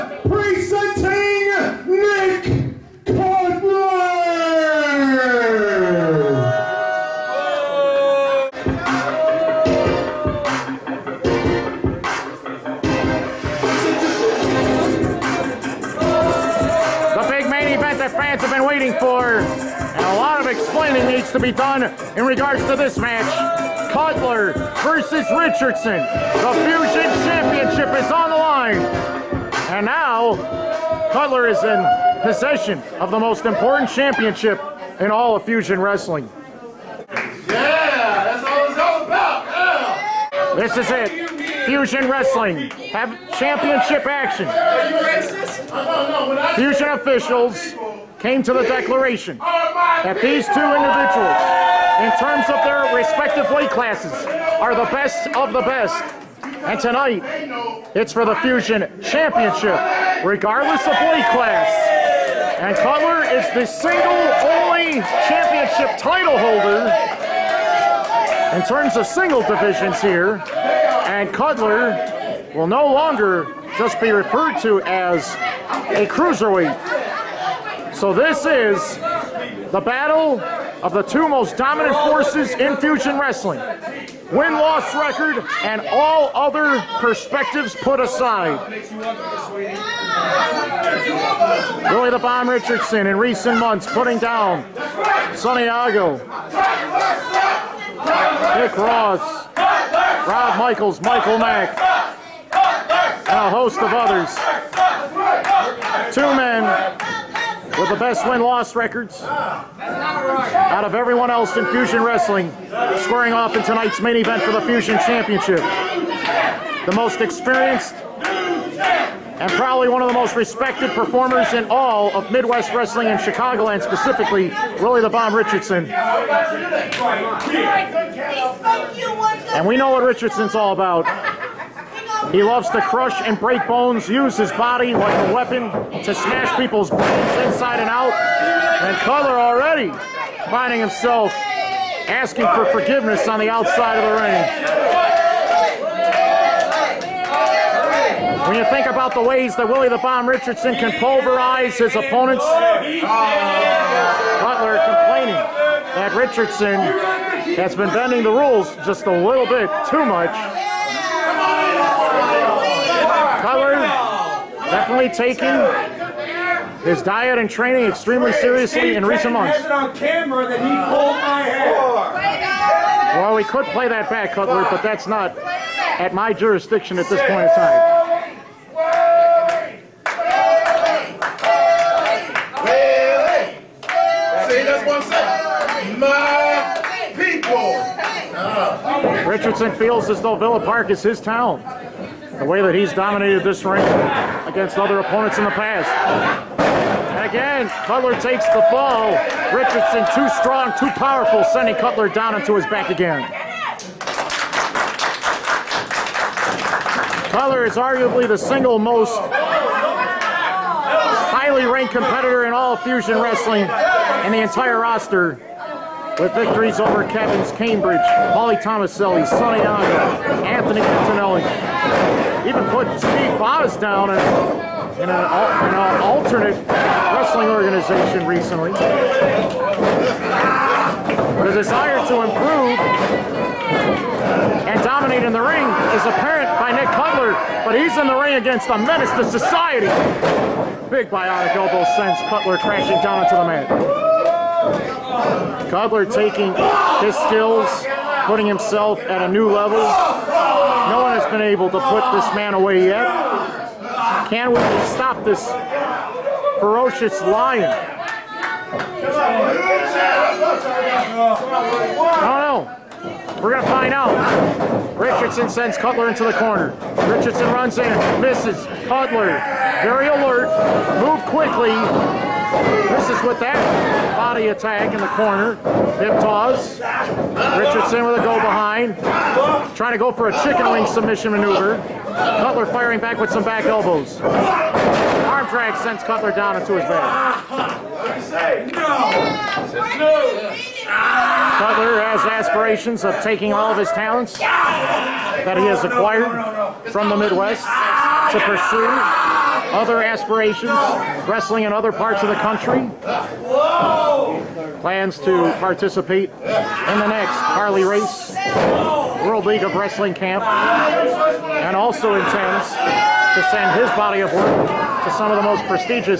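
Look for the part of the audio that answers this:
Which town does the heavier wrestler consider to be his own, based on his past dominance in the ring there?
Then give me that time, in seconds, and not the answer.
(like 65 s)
190 s.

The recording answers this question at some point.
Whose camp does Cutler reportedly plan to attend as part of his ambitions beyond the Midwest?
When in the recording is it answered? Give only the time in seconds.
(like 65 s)
307 s.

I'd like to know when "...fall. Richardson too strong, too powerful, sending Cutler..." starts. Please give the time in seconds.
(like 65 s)
198 s.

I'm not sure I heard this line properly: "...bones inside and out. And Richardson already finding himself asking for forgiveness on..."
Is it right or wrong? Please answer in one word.
wrong.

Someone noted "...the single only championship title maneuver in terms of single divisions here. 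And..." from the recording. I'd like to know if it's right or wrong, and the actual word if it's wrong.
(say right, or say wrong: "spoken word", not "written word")
wrong: "holder", not "maneuver".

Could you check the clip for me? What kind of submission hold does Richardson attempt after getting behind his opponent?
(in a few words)
Chicken wing.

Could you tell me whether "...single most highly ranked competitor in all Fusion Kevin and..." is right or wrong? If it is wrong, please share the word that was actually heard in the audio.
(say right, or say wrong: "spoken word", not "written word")
wrong: "Wrestling", not "Kevin".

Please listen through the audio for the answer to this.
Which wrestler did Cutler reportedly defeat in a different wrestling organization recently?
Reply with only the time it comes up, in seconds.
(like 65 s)
222 s.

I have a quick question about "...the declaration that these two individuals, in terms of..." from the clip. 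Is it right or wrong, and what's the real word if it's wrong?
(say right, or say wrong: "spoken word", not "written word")
right.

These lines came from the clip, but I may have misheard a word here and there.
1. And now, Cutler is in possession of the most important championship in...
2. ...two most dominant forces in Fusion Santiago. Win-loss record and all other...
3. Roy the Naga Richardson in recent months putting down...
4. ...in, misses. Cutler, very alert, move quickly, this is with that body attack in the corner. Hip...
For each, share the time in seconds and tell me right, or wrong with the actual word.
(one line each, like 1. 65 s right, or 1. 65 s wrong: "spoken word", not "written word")
1. 29 s right
2. 80 s wrong: "Wrestling", not "Santiago"
3. 91 s wrong: "Bomb", not "Naga"
4. 267 s right.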